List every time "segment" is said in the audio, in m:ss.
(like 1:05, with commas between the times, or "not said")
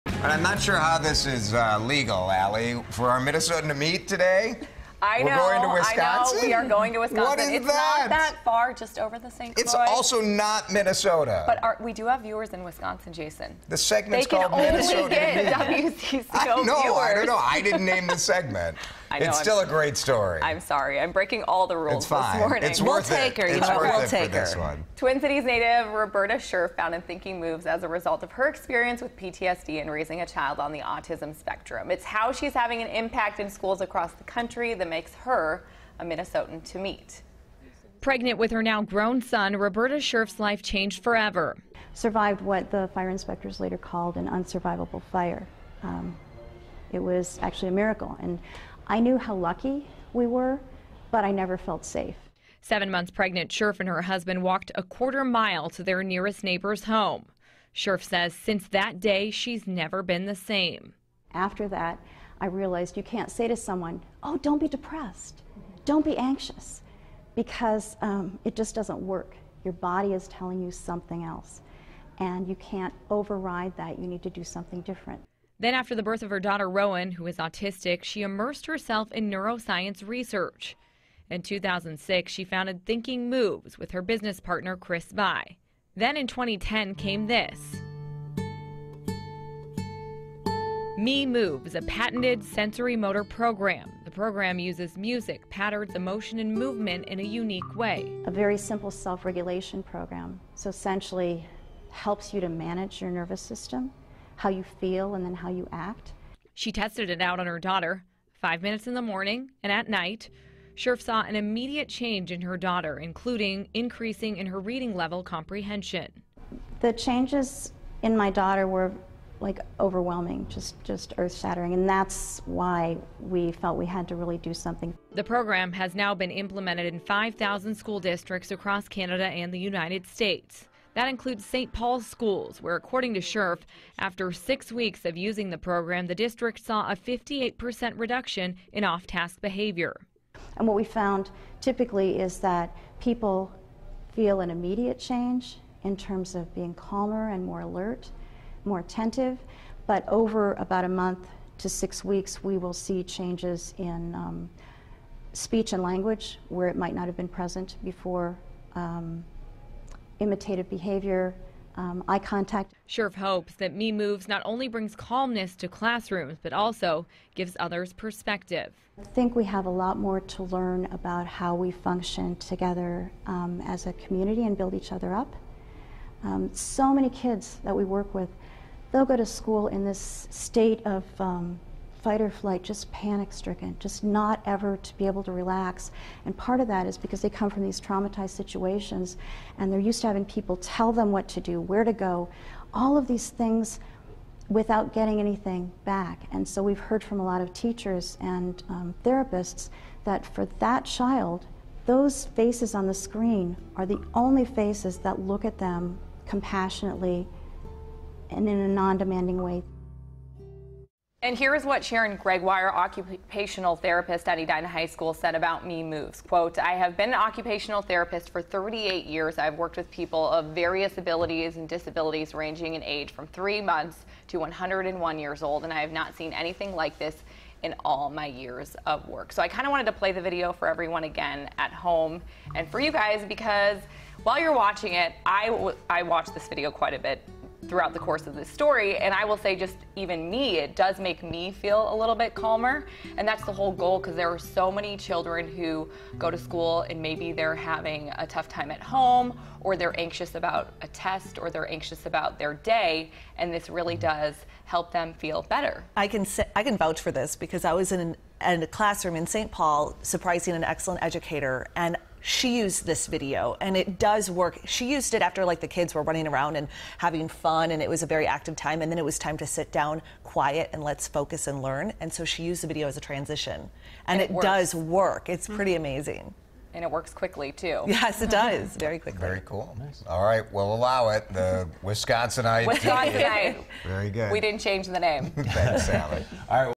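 0:13, 0:18.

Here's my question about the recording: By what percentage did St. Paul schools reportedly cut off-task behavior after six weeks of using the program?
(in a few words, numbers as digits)
58%.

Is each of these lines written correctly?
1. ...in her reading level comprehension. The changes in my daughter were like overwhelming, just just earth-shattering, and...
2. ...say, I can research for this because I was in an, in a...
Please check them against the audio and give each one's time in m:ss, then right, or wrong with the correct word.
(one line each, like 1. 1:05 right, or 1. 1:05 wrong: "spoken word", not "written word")
1. 1:54 right
2. 4:16 wrong: "vouch", not "research".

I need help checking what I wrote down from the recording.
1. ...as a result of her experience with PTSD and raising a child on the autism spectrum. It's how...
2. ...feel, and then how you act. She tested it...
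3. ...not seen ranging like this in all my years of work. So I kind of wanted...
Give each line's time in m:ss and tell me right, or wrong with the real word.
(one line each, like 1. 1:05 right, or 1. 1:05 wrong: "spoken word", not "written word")
1. 0:27 right
2. 1:44 right
3. 3:45 wrong: "anything", not "ranging".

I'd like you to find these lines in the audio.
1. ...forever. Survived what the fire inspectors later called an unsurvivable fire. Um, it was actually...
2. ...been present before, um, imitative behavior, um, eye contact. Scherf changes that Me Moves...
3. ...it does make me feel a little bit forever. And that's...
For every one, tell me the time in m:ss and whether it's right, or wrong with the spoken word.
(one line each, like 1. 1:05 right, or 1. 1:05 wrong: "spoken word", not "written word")
1. 0:41 right
2. 2:37 wrong: "hopes", not "changes"
3. 4:00 wrong: "calmer", not "forever".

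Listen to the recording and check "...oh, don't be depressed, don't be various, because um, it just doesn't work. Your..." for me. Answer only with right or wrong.
wrong.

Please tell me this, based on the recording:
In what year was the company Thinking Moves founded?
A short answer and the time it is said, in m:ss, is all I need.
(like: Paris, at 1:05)
2006, at 1:21.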